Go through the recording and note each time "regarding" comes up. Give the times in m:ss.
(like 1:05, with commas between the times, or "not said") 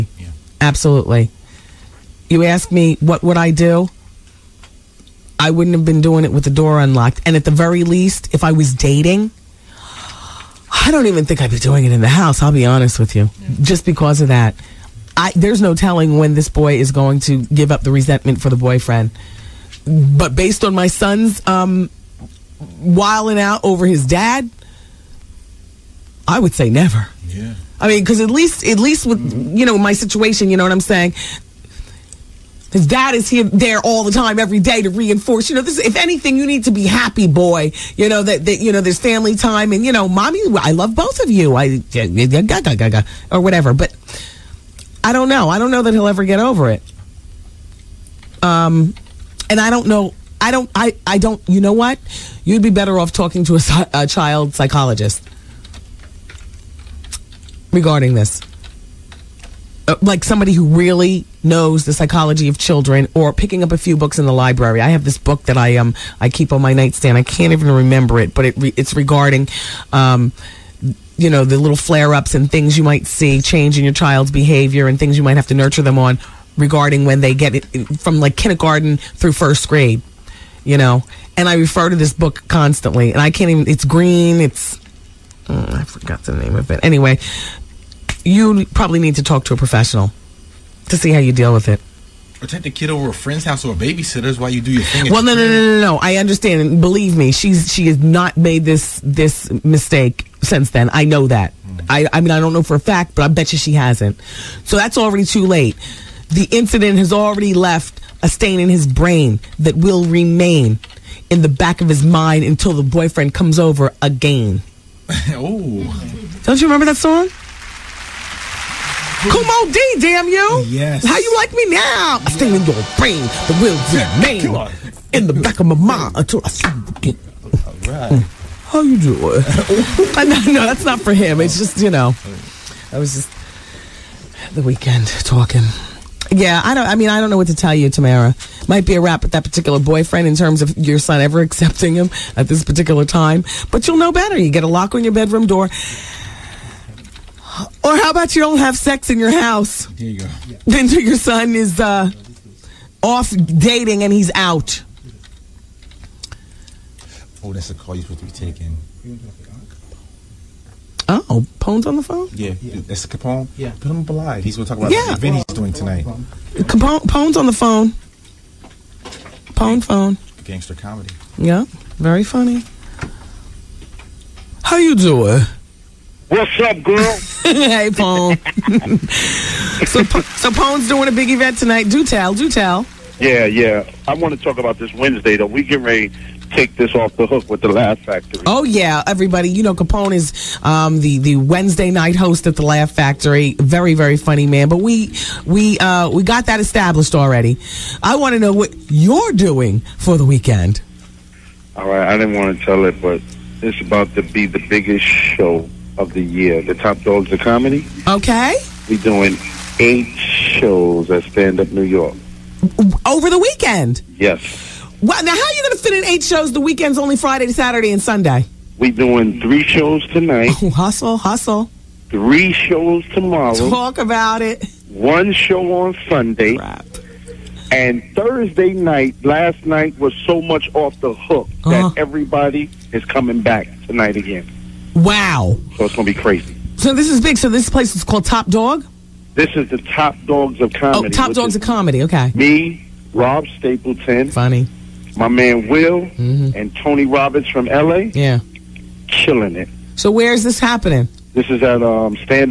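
0:57, 1:08, 1:16.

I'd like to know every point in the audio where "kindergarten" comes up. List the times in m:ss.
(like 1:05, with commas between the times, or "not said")
1:18.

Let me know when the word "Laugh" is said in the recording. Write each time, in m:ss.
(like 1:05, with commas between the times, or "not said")
3:07, 3:12.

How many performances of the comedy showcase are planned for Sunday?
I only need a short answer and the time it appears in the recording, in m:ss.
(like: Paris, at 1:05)
1, at 3:44.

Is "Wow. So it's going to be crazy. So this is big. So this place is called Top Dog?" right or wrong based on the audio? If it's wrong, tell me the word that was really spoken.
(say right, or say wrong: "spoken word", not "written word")
right.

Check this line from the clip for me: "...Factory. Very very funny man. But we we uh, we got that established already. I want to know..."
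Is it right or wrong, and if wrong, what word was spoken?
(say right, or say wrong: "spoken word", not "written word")
right.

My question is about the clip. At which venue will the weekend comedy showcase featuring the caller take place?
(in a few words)
Stand Up New York.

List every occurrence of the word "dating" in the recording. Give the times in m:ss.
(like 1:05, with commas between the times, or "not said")
0:08, 2:33.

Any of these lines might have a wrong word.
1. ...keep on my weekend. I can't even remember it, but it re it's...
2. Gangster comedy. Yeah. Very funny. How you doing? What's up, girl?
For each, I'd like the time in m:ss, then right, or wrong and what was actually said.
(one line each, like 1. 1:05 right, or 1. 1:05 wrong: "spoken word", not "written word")
1. 1:06 wrong: "nightstand", not "weekend"
2. 2:50 right.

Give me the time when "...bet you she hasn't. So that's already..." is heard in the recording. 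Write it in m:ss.
1:43.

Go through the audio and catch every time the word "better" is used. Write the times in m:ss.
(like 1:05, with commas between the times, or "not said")
0:52, 2:24.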